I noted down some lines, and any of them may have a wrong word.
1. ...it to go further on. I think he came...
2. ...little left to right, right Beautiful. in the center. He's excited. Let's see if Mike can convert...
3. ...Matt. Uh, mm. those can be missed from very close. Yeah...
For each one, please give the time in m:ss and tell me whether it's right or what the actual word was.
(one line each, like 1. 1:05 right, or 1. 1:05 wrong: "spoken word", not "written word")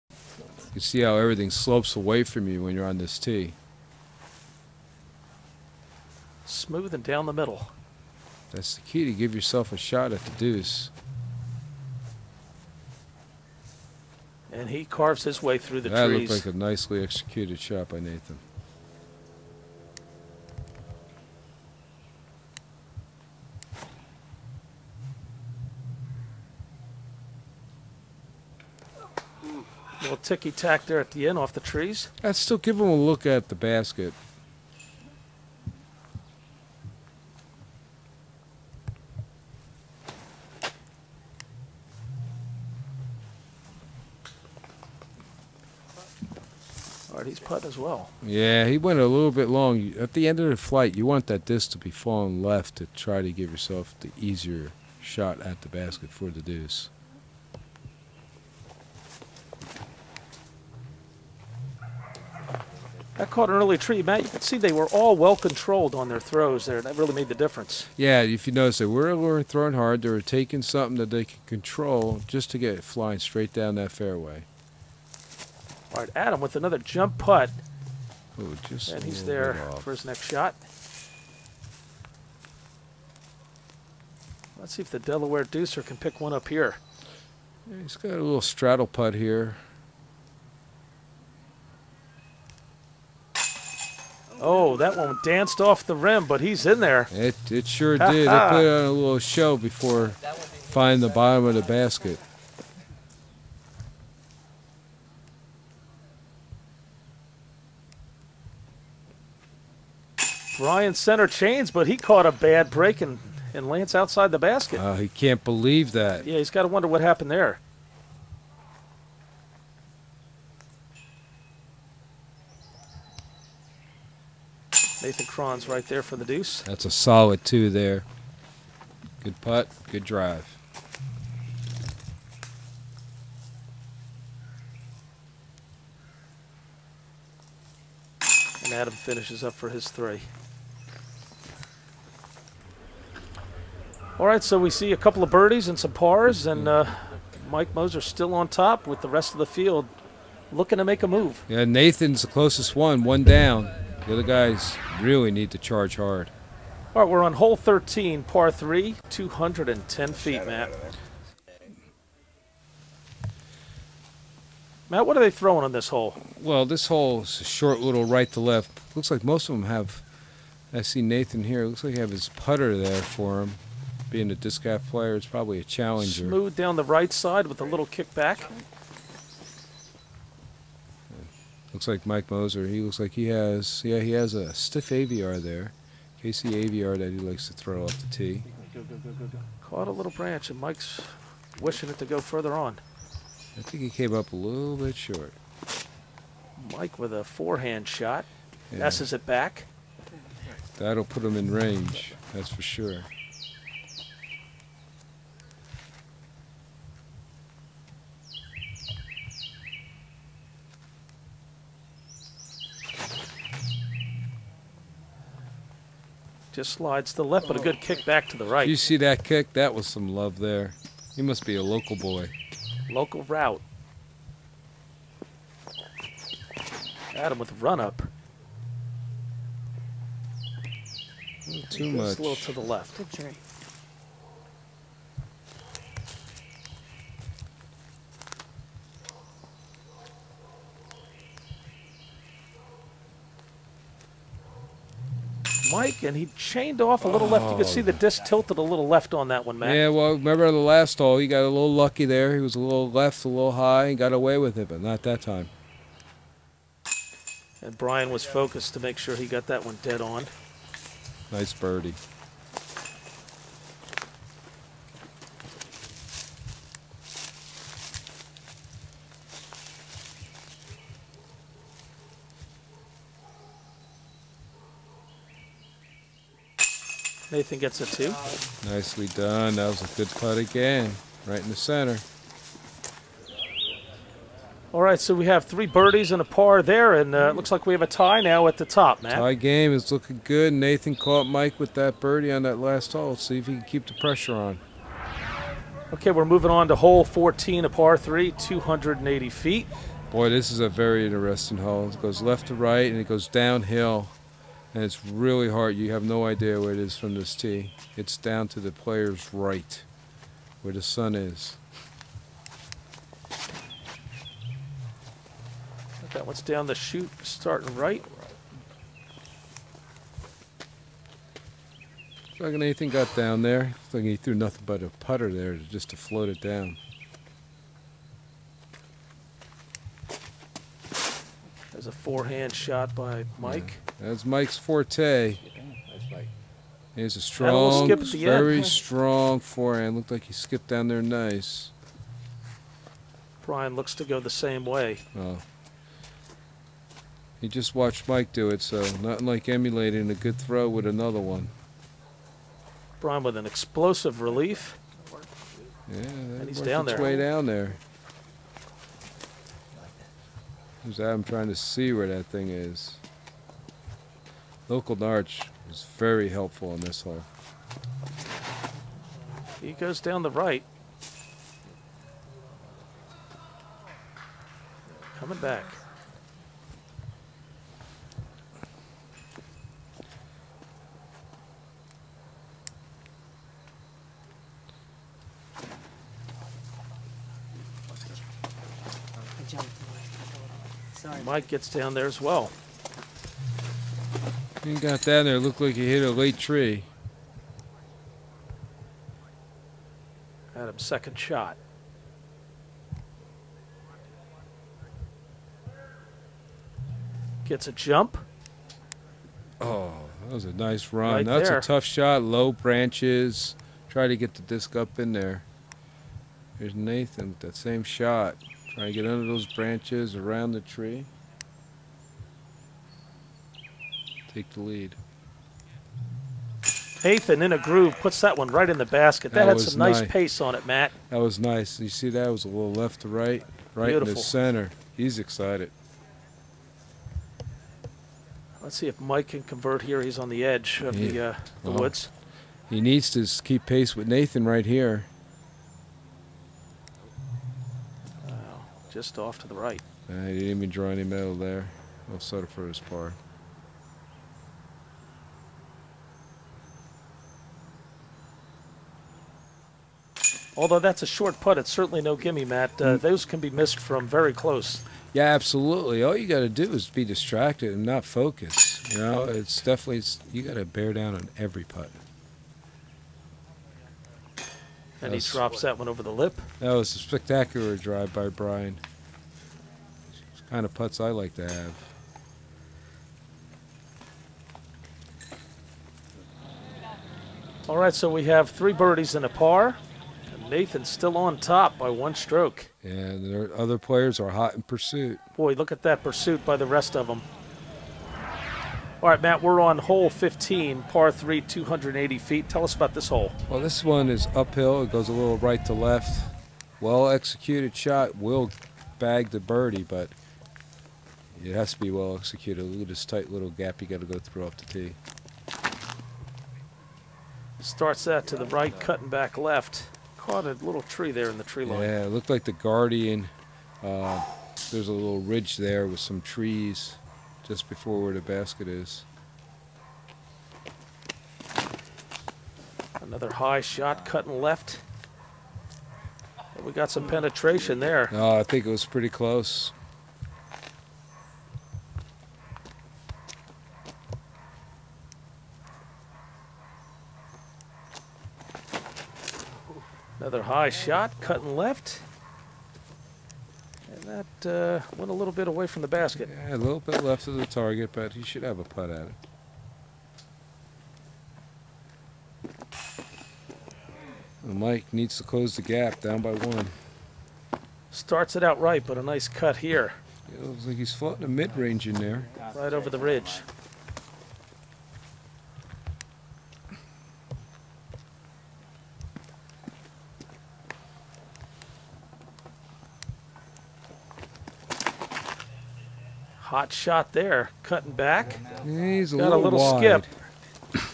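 1. 3:11 right
2. 7:12 right
3. 7:42 right.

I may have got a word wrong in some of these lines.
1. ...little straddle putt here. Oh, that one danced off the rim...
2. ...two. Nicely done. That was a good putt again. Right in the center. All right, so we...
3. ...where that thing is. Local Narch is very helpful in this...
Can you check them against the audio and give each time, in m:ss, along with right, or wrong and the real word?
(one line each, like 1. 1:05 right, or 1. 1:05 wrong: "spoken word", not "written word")
1. 1:28 right
2. 4:37 right
3. 6:01 right.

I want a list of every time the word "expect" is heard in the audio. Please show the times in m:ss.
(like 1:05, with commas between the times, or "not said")
not said.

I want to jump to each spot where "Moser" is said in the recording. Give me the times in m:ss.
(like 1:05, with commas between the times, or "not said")
2:27, 3:02.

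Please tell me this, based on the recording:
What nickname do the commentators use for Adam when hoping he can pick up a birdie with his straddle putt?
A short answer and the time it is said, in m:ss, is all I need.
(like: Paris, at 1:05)
Delaware Deucer, at 1:24.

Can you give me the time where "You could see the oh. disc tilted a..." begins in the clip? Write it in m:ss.
4:07.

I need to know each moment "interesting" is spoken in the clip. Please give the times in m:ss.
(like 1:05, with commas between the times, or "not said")
5:01.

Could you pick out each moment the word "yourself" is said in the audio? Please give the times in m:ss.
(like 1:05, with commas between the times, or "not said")
0:09, 0:53.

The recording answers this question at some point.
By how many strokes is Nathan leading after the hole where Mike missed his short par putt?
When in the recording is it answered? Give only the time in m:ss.
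8:11.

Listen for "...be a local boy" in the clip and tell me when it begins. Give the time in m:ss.
3:41.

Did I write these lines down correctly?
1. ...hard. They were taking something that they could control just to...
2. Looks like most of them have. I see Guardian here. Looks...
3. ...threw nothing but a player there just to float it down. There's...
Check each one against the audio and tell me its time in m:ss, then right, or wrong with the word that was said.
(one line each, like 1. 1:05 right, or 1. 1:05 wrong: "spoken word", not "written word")
1. 1:09 right
2. 2:48 wrong: "Nathan", not "Guardian"
3. 5:24 wrong: "putter", not "player".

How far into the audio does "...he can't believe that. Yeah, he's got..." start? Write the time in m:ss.
1:54.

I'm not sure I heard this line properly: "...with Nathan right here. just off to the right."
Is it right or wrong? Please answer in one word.
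right.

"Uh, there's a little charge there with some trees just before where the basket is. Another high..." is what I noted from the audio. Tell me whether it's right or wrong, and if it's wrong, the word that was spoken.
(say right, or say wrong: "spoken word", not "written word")
wrong: "ridge", not "charge".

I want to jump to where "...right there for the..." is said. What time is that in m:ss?
2:05.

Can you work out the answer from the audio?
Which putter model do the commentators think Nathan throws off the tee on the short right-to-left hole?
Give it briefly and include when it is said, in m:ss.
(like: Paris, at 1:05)
Challenger, at 2:55.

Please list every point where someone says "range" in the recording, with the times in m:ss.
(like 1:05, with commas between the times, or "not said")
3:21, 9:31.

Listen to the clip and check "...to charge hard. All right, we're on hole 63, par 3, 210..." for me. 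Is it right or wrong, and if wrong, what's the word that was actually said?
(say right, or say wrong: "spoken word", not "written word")
wrong: "13", not "63".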